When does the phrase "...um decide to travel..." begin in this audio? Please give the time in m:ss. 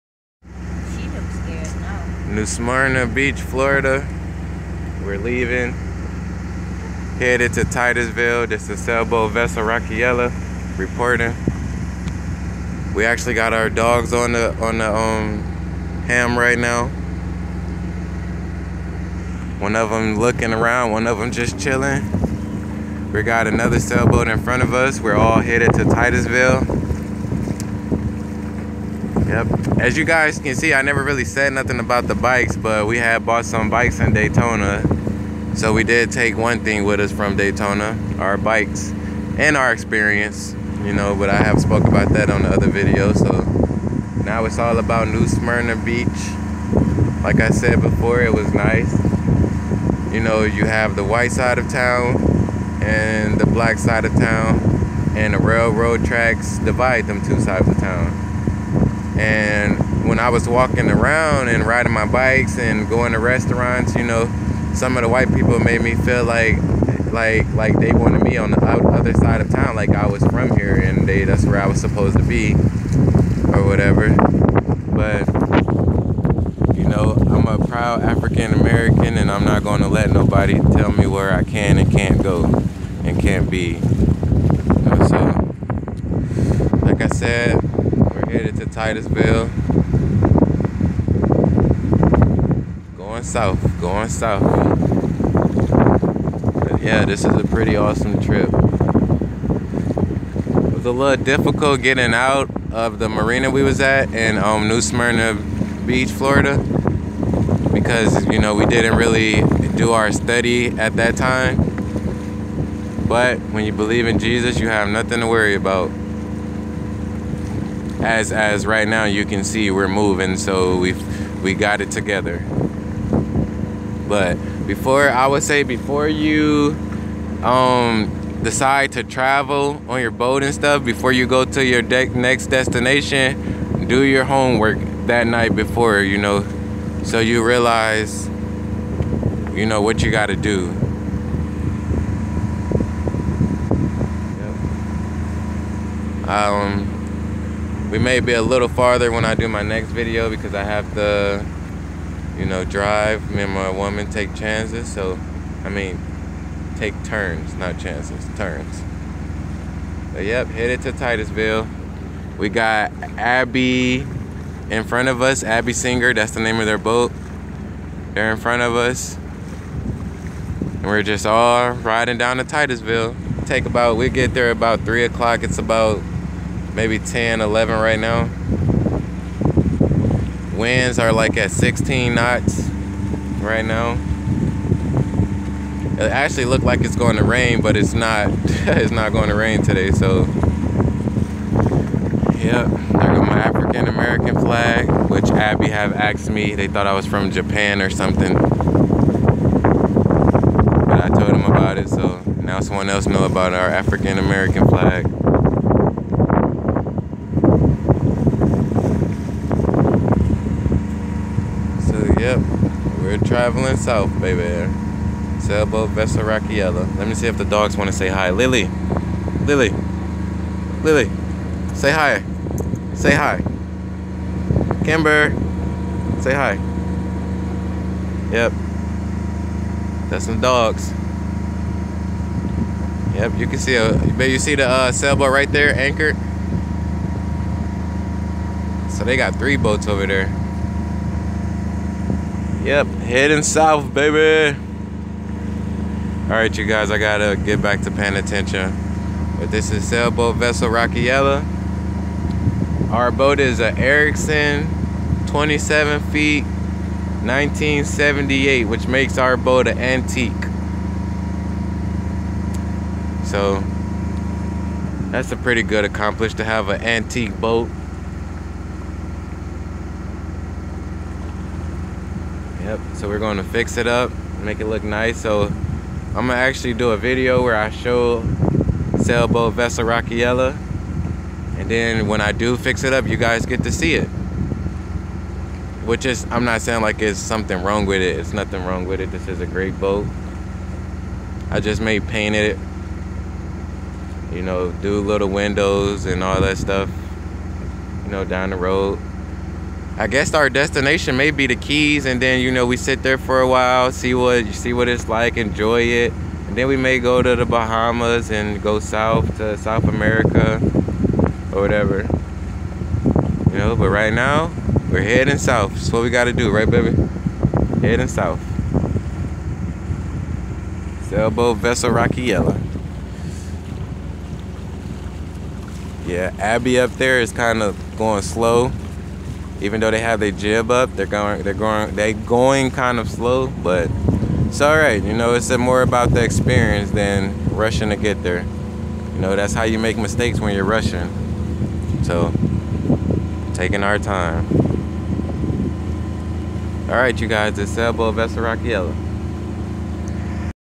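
2:07.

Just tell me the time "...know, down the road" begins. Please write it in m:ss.
4:58.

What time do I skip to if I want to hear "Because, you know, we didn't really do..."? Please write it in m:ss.
1:47.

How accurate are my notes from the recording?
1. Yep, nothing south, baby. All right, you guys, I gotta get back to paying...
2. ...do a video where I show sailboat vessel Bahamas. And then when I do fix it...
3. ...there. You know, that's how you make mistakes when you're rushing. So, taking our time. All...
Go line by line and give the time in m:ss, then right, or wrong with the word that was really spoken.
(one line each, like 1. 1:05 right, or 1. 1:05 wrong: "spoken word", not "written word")
1. 4:02 wrong: "heading", not "nothing"
2. 4:36 wrong: "Rockyelle", not "Bahamas"
3. 5:38 right.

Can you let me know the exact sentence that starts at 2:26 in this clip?
um we may be a little farther when I do my next video because I have to, you know, drive.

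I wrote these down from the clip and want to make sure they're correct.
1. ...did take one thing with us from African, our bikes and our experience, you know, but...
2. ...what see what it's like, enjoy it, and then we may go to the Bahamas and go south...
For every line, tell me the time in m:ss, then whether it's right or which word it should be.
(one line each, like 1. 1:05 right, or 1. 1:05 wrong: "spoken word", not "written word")
1. 0:35 wrong: "Daytona", not "African"
2. 5:04 right.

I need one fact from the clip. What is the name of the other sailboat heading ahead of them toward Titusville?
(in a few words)
Abby Singer.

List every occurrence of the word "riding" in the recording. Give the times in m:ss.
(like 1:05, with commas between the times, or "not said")
1:01, 2:51.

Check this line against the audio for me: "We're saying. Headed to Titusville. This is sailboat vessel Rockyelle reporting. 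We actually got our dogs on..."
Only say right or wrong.
wrong.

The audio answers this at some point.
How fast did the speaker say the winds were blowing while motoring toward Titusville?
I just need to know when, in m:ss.
3:01.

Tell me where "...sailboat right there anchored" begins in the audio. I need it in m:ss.
3:54.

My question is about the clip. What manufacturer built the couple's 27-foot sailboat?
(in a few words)
Ericson.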